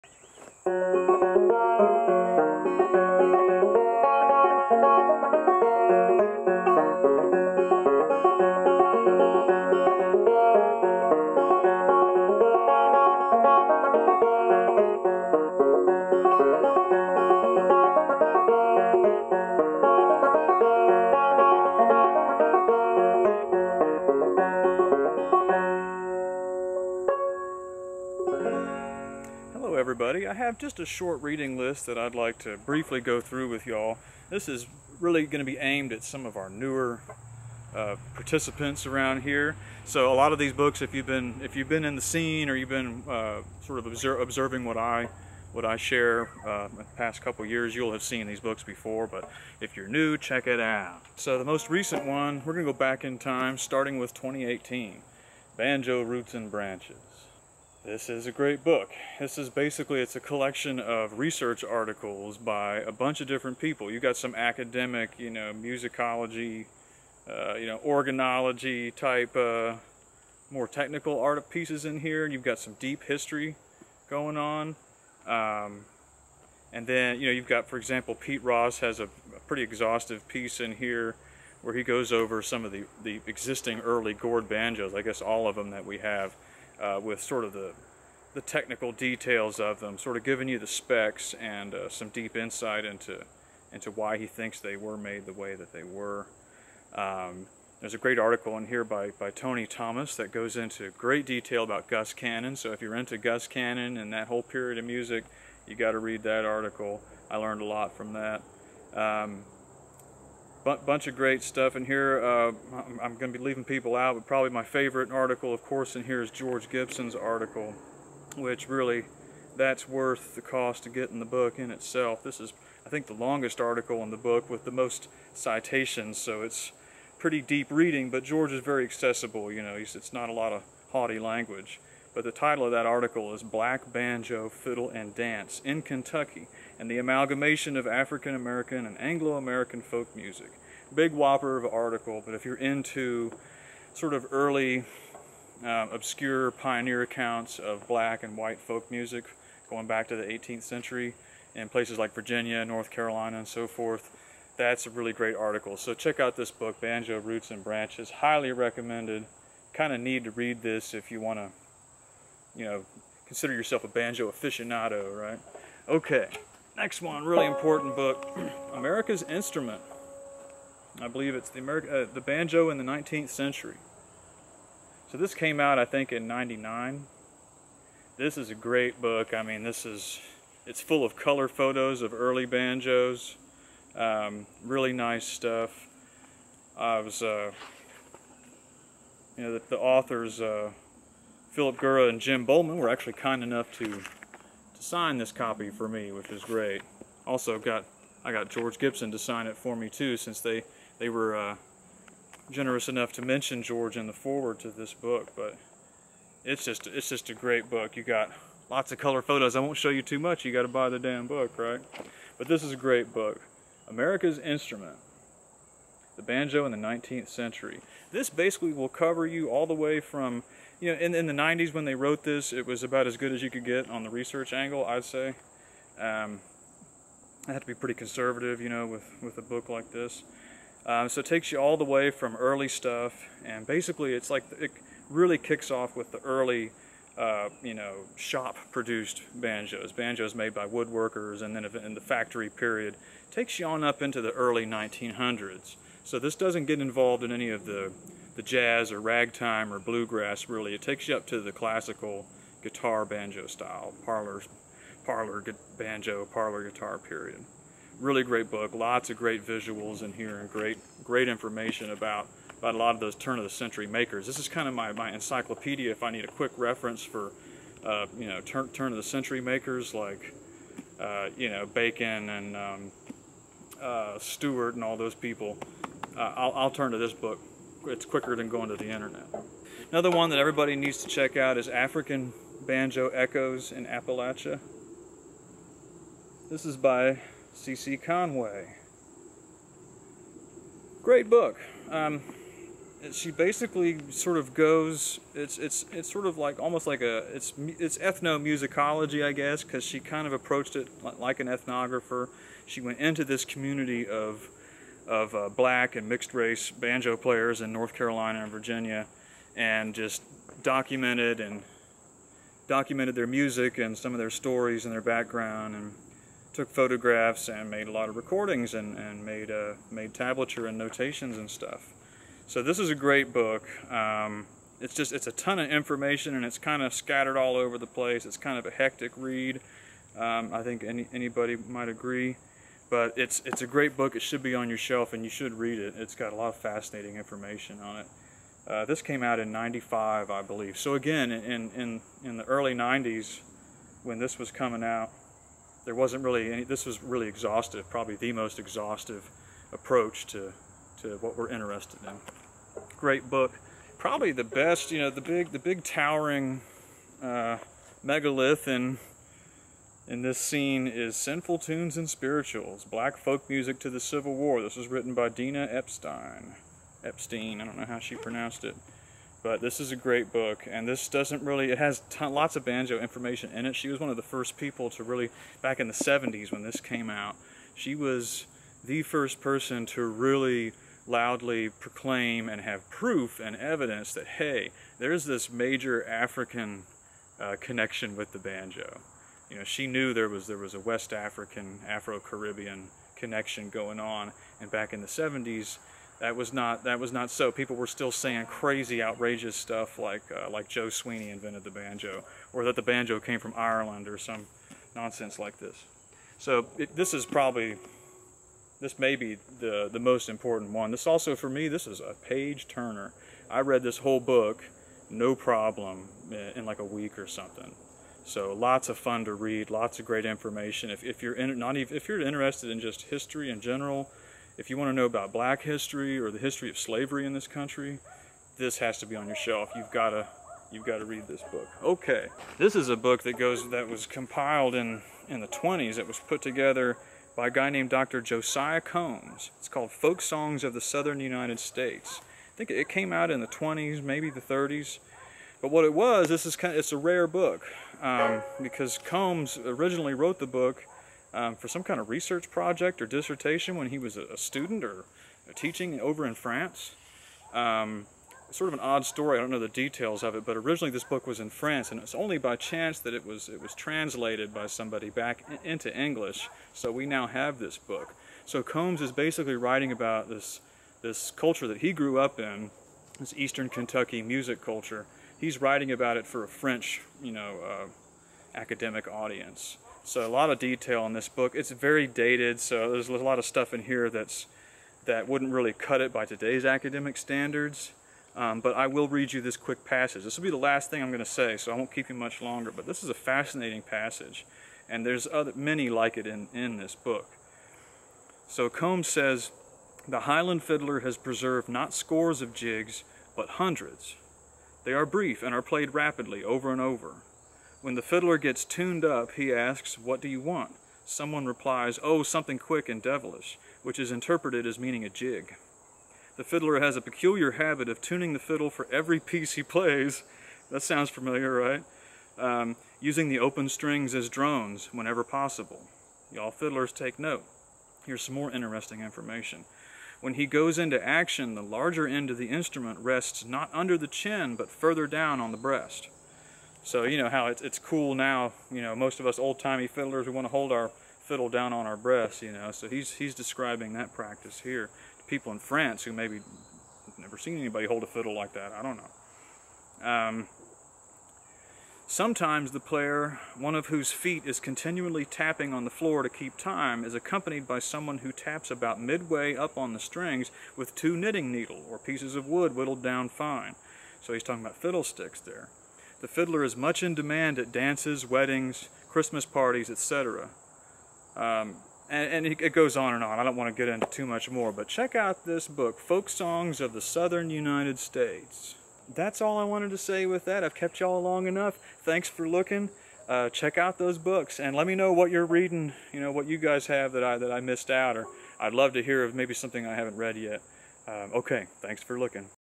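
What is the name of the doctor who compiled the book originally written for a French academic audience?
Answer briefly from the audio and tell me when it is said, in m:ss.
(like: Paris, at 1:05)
Josiah Combs, at 7:18.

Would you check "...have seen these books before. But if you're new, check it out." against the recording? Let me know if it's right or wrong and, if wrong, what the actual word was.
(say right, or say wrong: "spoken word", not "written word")
right.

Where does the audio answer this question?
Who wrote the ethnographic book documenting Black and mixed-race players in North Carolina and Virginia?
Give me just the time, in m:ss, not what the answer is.
4:47.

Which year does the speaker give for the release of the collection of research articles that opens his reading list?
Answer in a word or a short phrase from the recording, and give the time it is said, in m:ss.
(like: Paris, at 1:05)
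2018, at 0:54.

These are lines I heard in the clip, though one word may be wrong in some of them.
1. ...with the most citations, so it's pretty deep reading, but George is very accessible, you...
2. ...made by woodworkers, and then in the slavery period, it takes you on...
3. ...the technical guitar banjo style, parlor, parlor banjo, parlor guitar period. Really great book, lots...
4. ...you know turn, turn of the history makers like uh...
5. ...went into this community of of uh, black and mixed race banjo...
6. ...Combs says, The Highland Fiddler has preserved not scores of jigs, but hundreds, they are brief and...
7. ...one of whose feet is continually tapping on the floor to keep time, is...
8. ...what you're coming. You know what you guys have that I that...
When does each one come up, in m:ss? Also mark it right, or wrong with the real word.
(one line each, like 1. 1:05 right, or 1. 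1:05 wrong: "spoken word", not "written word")
1. 2:04 right
2. 4:00 wrong: "factory", not "slavery"
3. 4:11 wrong: "classical", not "technical"
4. 4:28 wrong: "century", not "history"
5. 5:02 right
6. 8:18 right
7. 9:13 right
8. 9:45 wrong: "reading", not "coming".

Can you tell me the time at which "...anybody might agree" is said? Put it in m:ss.
5:31.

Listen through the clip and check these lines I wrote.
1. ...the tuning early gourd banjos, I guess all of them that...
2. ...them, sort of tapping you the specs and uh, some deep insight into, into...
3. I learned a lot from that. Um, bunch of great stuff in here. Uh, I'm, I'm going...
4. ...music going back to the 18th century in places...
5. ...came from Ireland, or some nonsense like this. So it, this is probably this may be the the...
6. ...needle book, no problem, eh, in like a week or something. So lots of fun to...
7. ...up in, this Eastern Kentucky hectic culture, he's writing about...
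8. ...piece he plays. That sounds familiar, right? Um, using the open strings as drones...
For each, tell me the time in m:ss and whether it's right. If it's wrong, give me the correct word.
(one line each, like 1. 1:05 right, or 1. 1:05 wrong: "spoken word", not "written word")
1. 1:23 wrong: "existing", not "tuning"
2. 1:29 wrong: "giving", not "tapping"
3. 1:47 right
4. 2:28 right
5. 6:43 right
6. 6:53 wrong: "whole", not "needle"
7. 7:52 wrong: "music", not "hectic"
8. 8:39 right.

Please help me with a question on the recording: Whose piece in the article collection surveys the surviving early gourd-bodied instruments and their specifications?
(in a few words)
Pete Ross.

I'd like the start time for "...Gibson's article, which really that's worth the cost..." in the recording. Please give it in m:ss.
1:56.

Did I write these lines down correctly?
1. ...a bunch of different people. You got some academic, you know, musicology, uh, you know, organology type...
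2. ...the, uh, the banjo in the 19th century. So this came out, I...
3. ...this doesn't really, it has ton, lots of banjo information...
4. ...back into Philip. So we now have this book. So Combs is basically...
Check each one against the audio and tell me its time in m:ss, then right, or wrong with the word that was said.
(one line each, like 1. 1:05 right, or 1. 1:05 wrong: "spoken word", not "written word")
1. 1:02 right
2. 2:51 right
3. 6:10 right
4. 7:45 wrong: "English", not "Philip".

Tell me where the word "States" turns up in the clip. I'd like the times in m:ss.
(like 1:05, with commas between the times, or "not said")
7:21, 9:37.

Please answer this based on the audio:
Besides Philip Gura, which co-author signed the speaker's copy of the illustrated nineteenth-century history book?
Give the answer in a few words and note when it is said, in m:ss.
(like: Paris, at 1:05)
Jim Bollman, at 3:12.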